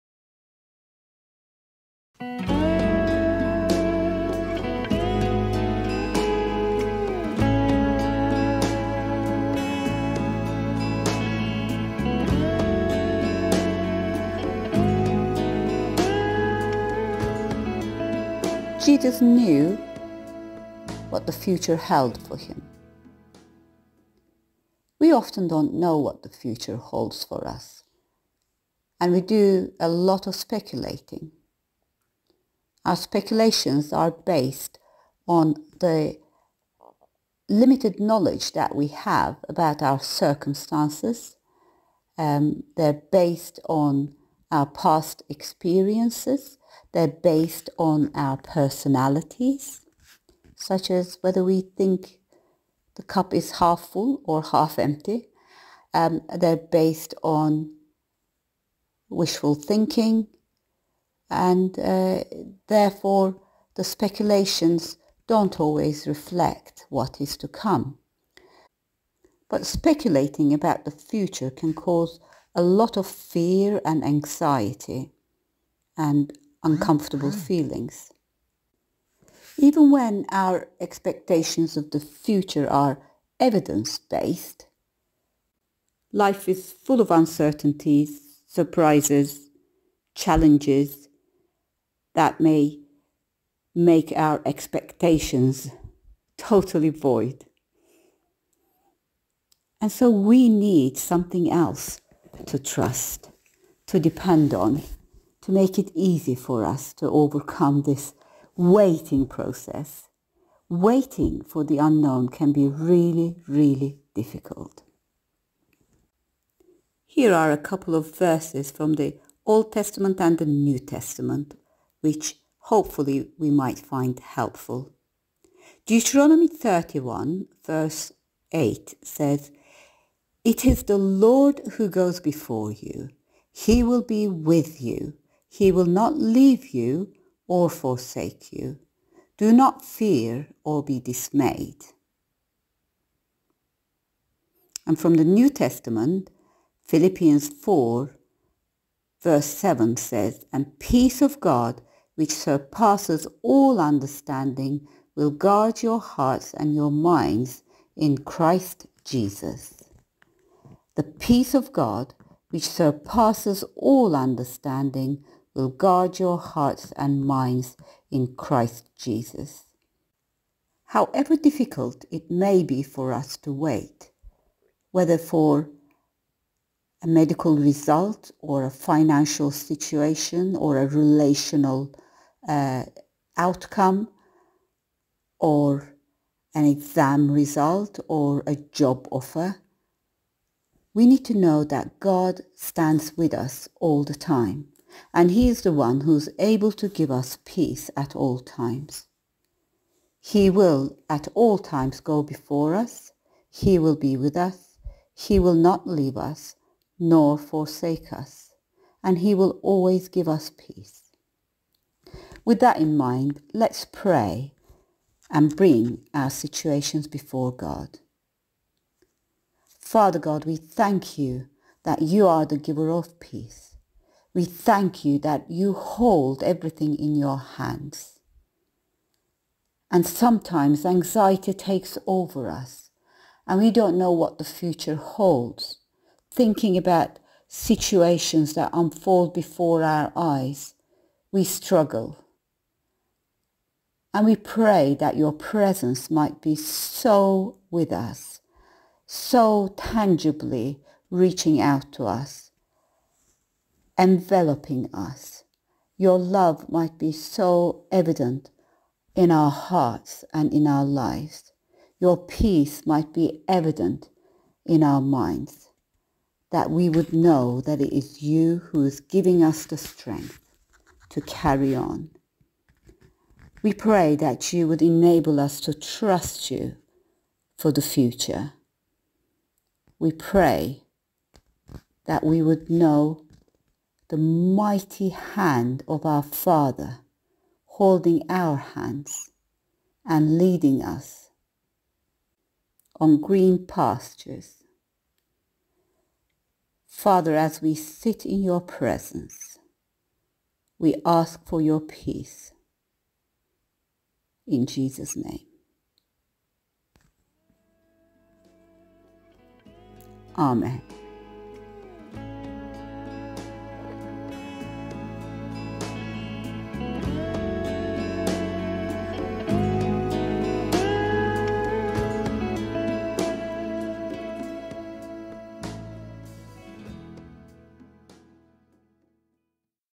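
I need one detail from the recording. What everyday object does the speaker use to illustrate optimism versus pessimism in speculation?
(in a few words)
the cup.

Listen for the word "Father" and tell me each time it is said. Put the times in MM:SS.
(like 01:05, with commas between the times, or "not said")
03:39, 04:46, 04:56.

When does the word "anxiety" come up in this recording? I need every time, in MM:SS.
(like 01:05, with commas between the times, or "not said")
01:14, 03:50.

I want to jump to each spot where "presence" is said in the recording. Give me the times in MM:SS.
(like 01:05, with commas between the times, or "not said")
04:05, 04:58.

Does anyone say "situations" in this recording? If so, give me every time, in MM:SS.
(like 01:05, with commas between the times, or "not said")
02:59, 03:36, 03:57.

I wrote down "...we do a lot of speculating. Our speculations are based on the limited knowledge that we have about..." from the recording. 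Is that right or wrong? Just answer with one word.
right.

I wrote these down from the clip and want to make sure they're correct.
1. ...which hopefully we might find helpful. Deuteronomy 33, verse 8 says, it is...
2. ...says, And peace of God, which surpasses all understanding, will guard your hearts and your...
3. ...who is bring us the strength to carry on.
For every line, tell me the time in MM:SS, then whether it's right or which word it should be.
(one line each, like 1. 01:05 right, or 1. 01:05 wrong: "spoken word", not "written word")
1. 02:01 wrong: "31", not "33"
2. 02:29 right
3. 04:28 wrong: "giving", not "bring".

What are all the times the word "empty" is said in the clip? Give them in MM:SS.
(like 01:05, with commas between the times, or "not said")
00:54.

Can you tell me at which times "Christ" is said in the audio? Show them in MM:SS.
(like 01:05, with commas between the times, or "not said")
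02:38, 02:48.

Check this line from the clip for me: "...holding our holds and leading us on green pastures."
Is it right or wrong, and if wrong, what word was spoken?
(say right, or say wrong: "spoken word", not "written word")
wrong: "hands", not "holds".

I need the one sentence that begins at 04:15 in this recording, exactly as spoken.
Your love might be so evident in our hearts and in our lives.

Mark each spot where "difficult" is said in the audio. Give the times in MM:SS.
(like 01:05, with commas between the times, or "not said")
01:54, 02:51.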